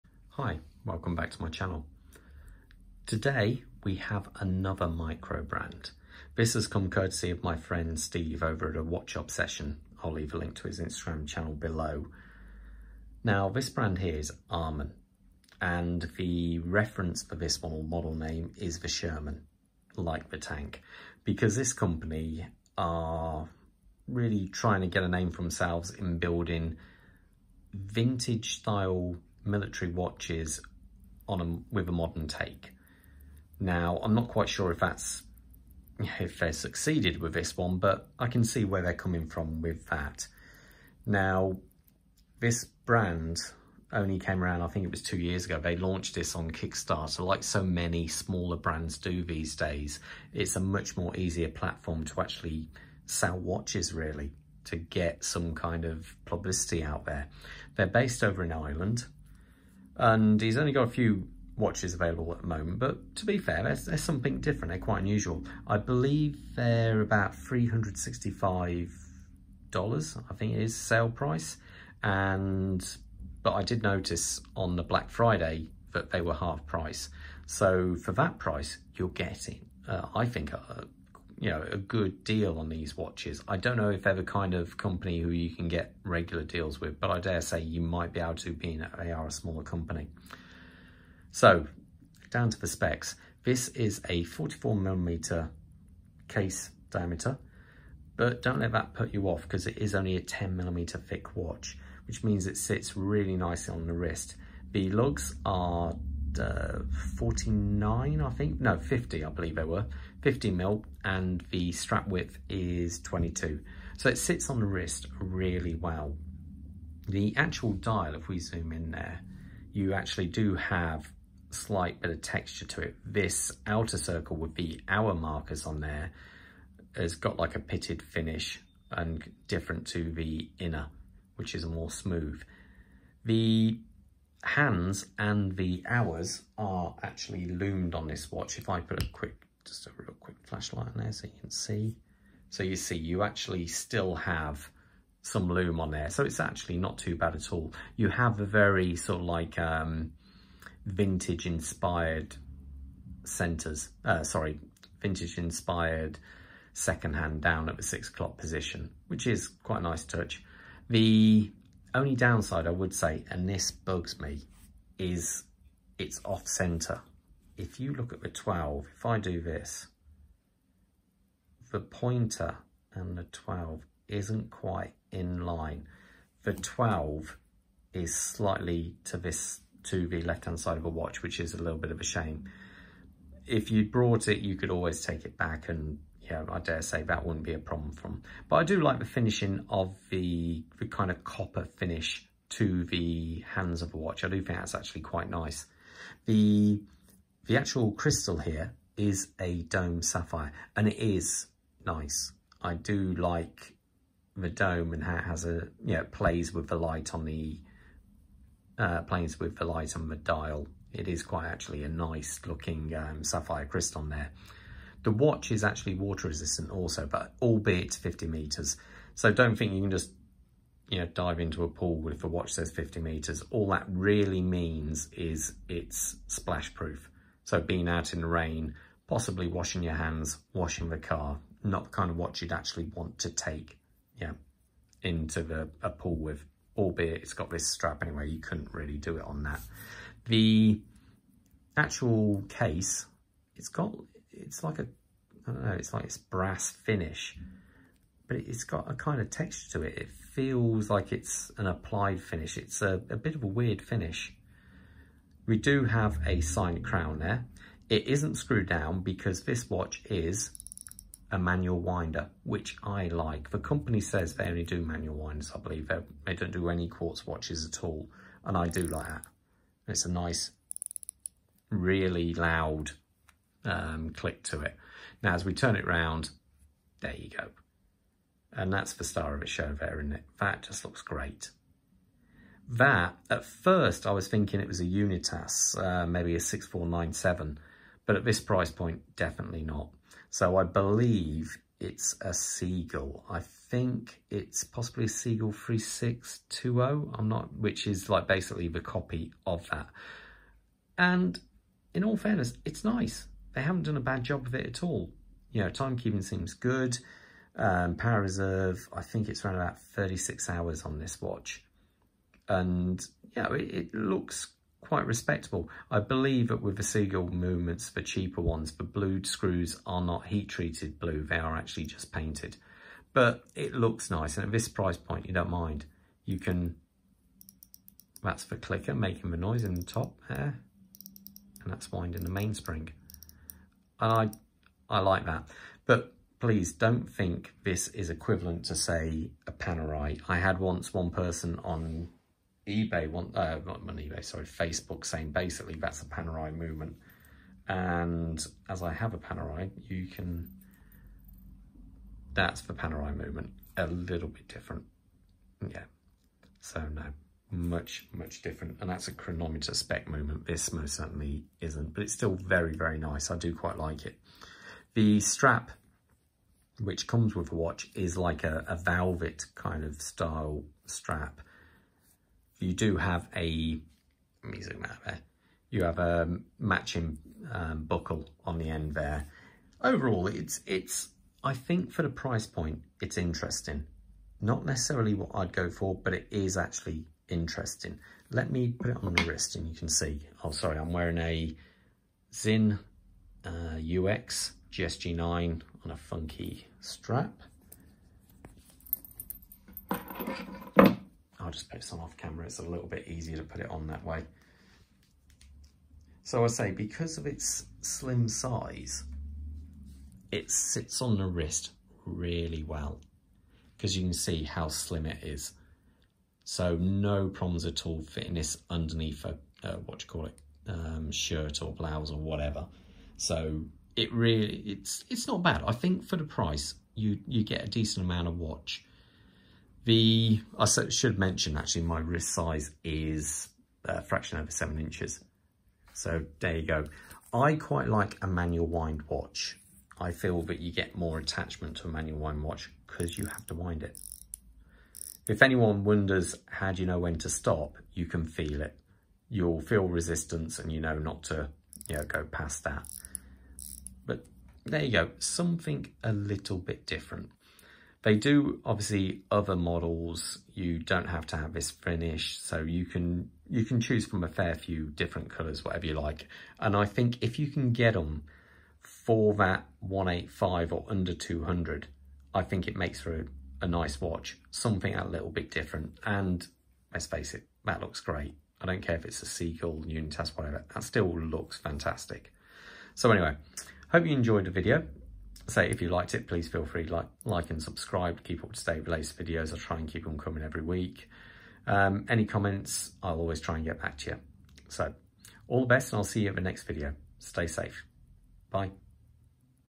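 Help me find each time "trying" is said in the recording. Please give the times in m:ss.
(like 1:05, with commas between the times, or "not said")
0:24.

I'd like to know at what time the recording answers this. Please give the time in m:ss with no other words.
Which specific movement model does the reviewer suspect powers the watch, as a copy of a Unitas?
4:55.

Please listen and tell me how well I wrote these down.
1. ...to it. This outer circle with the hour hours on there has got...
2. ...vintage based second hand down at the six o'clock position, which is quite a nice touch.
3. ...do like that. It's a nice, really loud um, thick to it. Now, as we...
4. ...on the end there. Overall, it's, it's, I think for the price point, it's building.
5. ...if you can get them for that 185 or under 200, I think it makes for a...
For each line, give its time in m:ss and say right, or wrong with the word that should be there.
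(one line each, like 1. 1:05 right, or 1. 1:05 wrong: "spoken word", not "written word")
1. 2:02 wrong: "markers", not "hours"
2. 2:35 wrong: "inspired", not "based"
3. 4:28 wrong: "click", not "thick"
4. 6:18 wrong: "interesting", not "building"
5. 7:47 right.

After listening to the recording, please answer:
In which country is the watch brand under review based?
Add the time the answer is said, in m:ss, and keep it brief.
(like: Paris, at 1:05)
Ireland, at 0:58.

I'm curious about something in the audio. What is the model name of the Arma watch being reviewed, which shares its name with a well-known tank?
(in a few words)
Sherman.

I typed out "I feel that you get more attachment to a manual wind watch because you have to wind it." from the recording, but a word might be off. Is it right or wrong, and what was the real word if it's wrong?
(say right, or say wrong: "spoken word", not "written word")
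right.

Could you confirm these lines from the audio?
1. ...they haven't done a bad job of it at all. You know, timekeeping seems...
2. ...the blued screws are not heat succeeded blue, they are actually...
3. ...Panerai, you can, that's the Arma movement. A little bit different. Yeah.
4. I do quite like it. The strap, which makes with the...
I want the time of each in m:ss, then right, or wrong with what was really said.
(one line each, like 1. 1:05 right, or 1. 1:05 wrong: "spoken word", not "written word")
1. 5:03 right
2. 5:18 wrong: "treated", not "succeeded"
3. 5:49 wrong: "Panerai", not "Arma"
4. 6:03 wrong: "comes", not "makes".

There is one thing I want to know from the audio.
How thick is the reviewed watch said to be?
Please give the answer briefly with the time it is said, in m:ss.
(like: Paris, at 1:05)
10 millimeters, at 1:40.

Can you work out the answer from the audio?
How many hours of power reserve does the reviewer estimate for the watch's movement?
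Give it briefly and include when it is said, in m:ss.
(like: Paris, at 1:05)
36 hours, at 5:09.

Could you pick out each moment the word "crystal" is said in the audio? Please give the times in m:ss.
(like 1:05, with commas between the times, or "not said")
3:17, 3:33.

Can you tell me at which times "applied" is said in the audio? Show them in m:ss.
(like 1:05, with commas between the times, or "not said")
4:11.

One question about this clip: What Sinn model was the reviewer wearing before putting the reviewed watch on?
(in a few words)
UX GSG9.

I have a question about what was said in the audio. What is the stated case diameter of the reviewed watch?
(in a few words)
44 millimeters.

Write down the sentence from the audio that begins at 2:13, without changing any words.
The hands and the hours are actually loomed on this watch.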